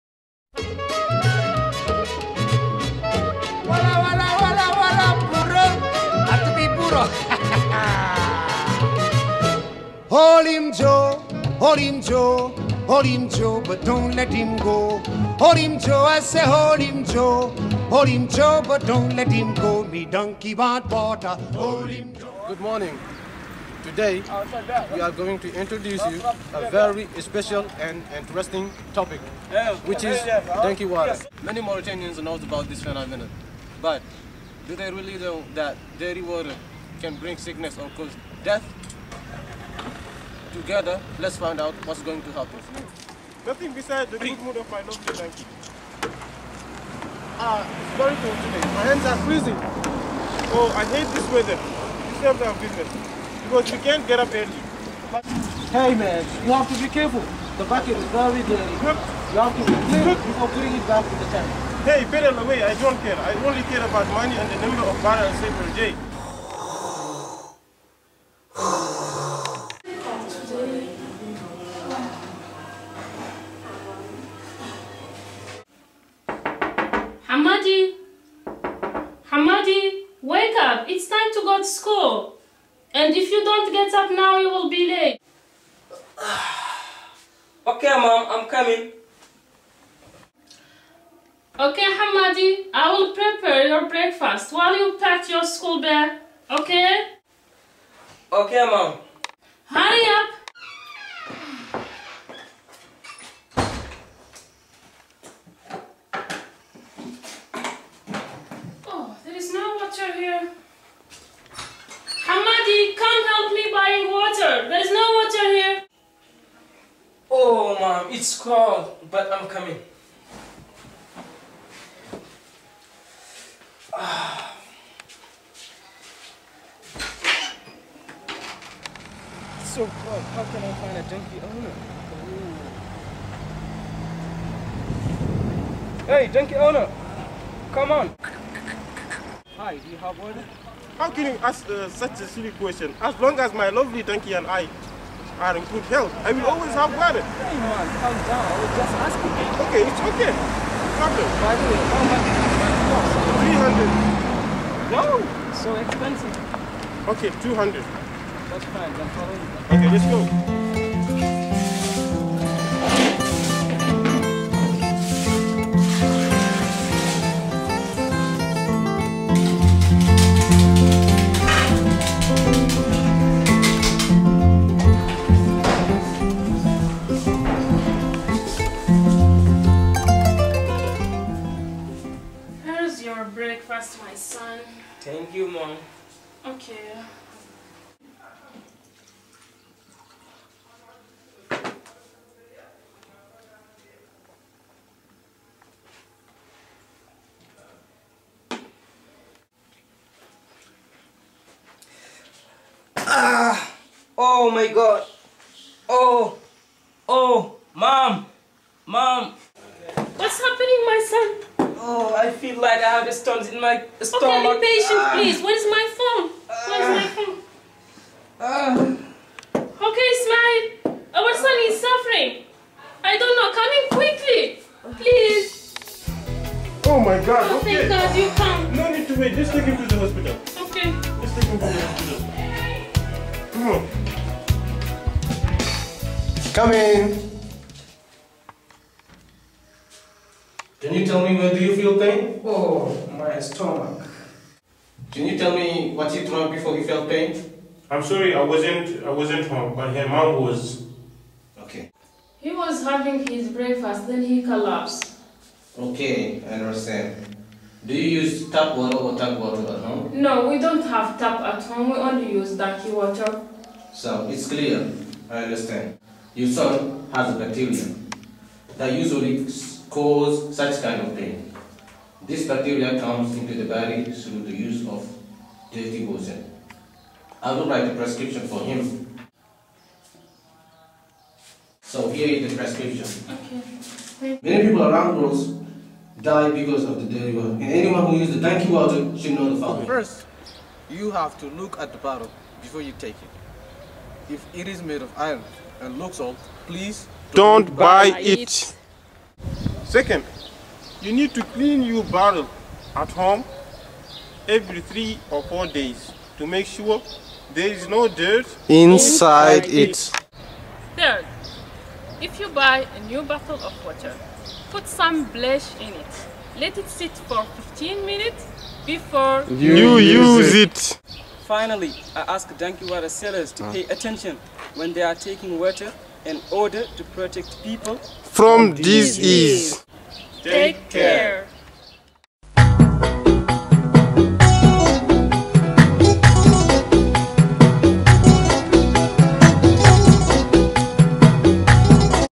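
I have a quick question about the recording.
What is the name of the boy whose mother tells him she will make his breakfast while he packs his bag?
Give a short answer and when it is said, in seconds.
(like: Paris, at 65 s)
Hamadi, at 91 s.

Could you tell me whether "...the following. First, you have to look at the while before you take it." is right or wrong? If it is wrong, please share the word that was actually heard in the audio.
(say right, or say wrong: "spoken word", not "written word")
wrong: "bottle", not "while".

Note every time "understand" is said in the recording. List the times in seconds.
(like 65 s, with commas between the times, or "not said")
256 s, 265 s.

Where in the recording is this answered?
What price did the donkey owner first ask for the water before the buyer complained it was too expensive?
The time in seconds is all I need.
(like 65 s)
154 s.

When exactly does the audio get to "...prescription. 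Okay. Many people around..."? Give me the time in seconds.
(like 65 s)
282 s.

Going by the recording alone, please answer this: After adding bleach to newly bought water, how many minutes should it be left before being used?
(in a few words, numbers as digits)
15 minutes.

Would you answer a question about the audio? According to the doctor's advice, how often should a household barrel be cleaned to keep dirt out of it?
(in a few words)
every 3 or 4 days.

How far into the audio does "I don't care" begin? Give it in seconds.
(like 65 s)
62 s.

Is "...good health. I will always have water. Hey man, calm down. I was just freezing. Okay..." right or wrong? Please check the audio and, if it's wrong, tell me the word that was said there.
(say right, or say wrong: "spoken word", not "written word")
wrong: "asking", not "freezing".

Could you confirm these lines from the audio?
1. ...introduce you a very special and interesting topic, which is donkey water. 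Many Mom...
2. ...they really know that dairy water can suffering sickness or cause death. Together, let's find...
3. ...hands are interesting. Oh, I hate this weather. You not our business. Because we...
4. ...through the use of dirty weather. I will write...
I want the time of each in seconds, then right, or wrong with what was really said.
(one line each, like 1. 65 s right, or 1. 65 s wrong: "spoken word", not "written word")
1. 25 s wrong: "Mauritanians", not "Mom"
2. 34 s wrong: "bring", not "suffering"
3. 48 s wrong: "freezing", not "interesting"
4. 274 s wrong: "water", not "weather".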